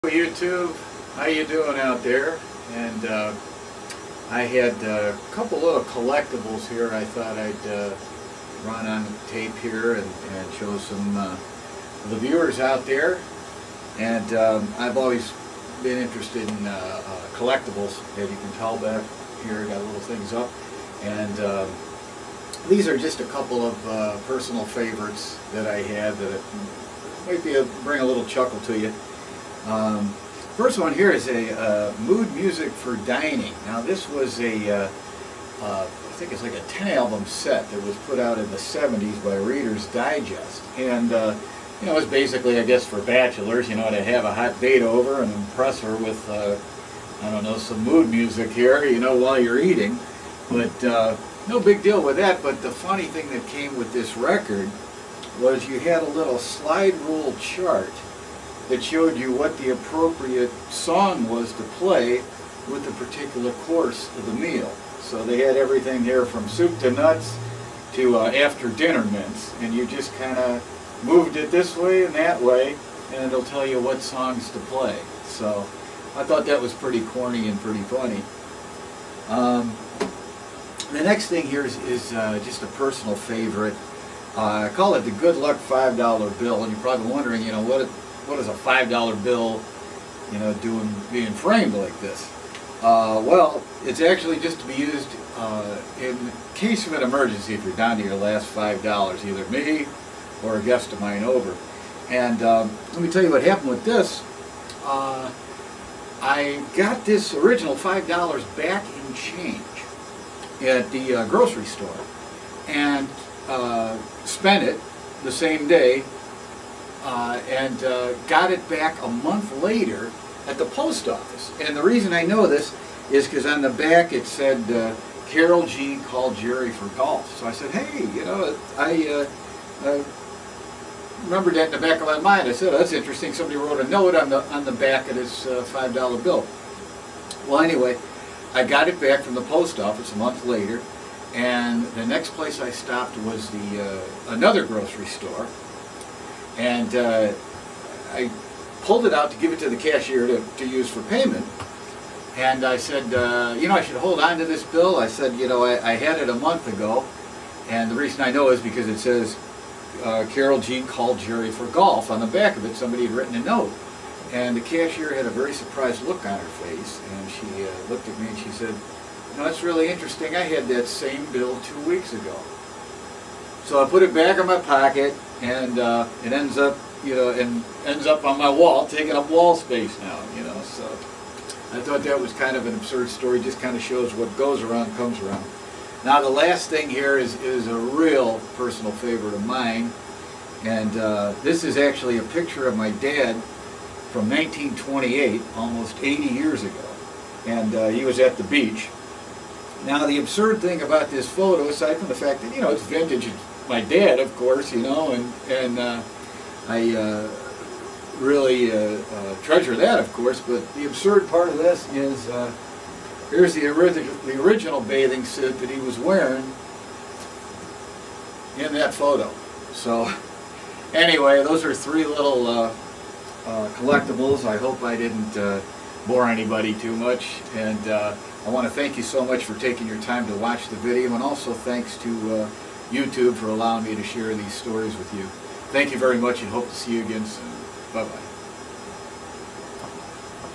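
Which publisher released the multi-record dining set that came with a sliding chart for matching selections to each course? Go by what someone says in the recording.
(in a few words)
Reader's Digest.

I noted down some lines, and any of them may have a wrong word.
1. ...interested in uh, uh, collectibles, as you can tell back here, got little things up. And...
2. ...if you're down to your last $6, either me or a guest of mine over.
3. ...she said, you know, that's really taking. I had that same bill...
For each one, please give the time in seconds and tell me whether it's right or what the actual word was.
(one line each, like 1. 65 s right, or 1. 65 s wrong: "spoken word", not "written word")
1. 16 s right
2. 97 s wrong: "5", not "6"
3. 168 s wrong: "interesting", not "taking".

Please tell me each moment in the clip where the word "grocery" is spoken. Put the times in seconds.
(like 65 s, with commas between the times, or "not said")
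111 s, 144 s.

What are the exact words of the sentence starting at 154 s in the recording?
I said, you know, I, I had it a month ago.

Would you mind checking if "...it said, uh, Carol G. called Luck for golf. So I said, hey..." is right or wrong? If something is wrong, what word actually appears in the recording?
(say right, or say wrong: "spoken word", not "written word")
wrong: "Jerry", not "Luck".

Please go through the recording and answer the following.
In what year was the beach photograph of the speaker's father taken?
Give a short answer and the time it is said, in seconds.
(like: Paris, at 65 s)
1928, at 194 s.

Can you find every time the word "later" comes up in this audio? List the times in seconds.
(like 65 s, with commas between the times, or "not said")
119 s, 140 s.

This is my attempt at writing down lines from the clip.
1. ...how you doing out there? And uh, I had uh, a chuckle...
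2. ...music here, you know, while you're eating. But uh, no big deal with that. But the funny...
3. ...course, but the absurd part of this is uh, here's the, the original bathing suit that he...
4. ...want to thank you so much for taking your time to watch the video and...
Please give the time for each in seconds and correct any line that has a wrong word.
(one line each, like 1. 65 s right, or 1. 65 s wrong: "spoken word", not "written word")
1. 1 s wrong: "couple", not "chuckle"
2. 48 s right
3. 210 s right
4. 228 s right.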